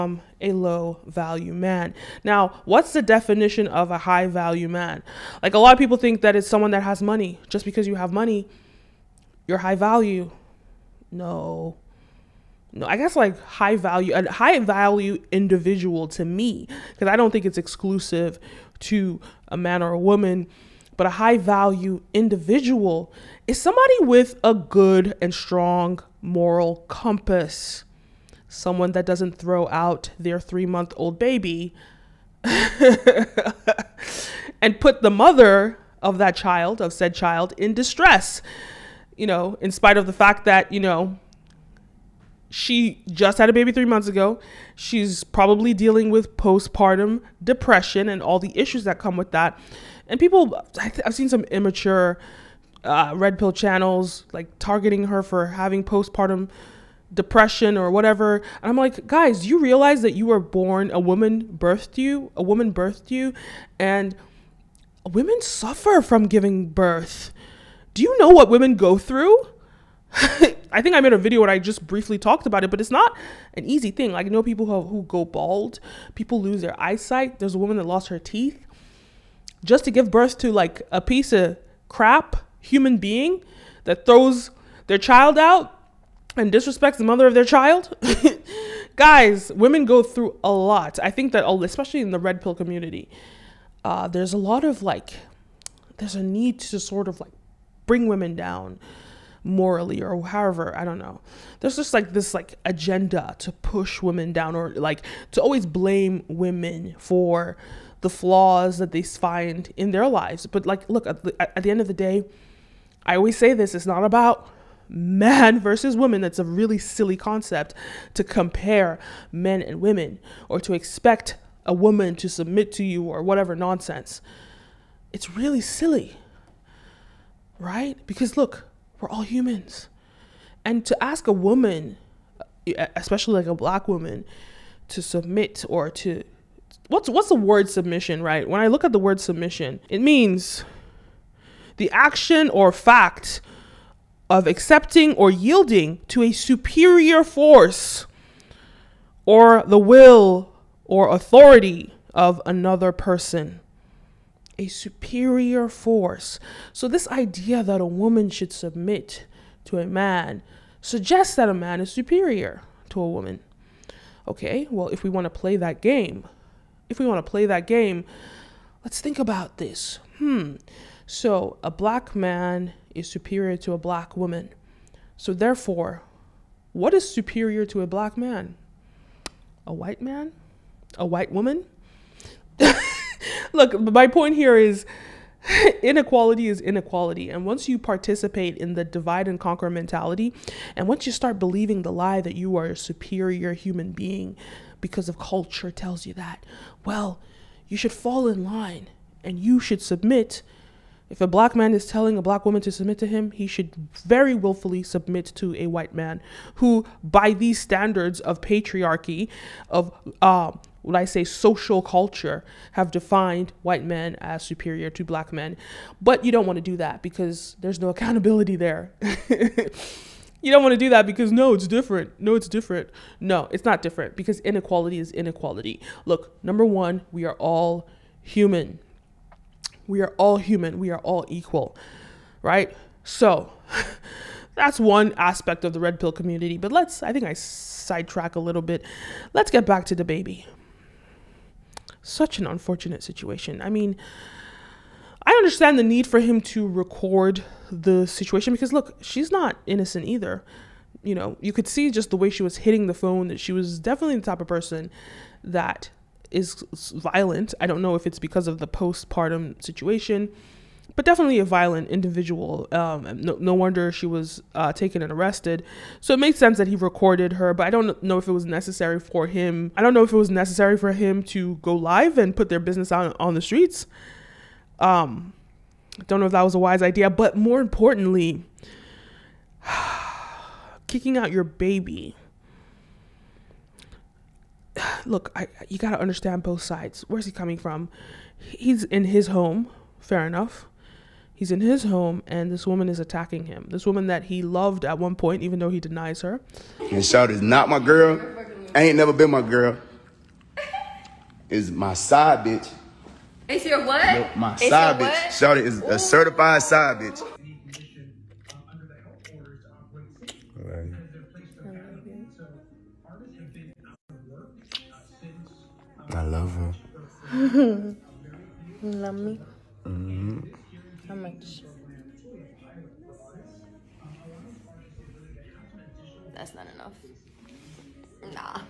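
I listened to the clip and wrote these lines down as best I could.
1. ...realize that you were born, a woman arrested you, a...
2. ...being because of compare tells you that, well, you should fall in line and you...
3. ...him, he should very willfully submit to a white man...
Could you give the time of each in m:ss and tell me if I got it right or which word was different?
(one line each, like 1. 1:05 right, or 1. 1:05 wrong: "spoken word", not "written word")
1. 0:59 wrong: "birthed", not "arrested"
2. 3:13 wrong: "culture", not "compare"
3. 3:23 right.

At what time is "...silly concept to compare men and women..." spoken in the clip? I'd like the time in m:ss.
1:56.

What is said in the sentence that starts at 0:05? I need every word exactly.
Like a lot of people think that it's someone that has money.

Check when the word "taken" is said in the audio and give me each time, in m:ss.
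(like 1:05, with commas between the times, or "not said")
4:24.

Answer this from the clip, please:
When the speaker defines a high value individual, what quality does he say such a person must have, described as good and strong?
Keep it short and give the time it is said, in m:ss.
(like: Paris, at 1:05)
Moral compass, at 0:26.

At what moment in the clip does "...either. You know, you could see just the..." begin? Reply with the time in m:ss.
4:10.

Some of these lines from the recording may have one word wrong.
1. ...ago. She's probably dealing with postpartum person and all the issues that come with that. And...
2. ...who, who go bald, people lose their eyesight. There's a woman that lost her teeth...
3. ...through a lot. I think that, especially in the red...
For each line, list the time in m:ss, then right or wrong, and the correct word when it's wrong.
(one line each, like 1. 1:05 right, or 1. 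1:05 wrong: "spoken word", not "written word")
1. 0:44 wrong: "depression", not "person"
2. 1:14 right
3. 1:30 right.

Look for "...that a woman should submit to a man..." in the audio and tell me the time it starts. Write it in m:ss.
2:37.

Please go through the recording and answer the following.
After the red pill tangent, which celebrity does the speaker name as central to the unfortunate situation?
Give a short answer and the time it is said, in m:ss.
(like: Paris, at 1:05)
DaBaby, at 3:59.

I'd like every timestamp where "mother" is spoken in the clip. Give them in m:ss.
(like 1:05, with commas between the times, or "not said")
0:35, 1:27.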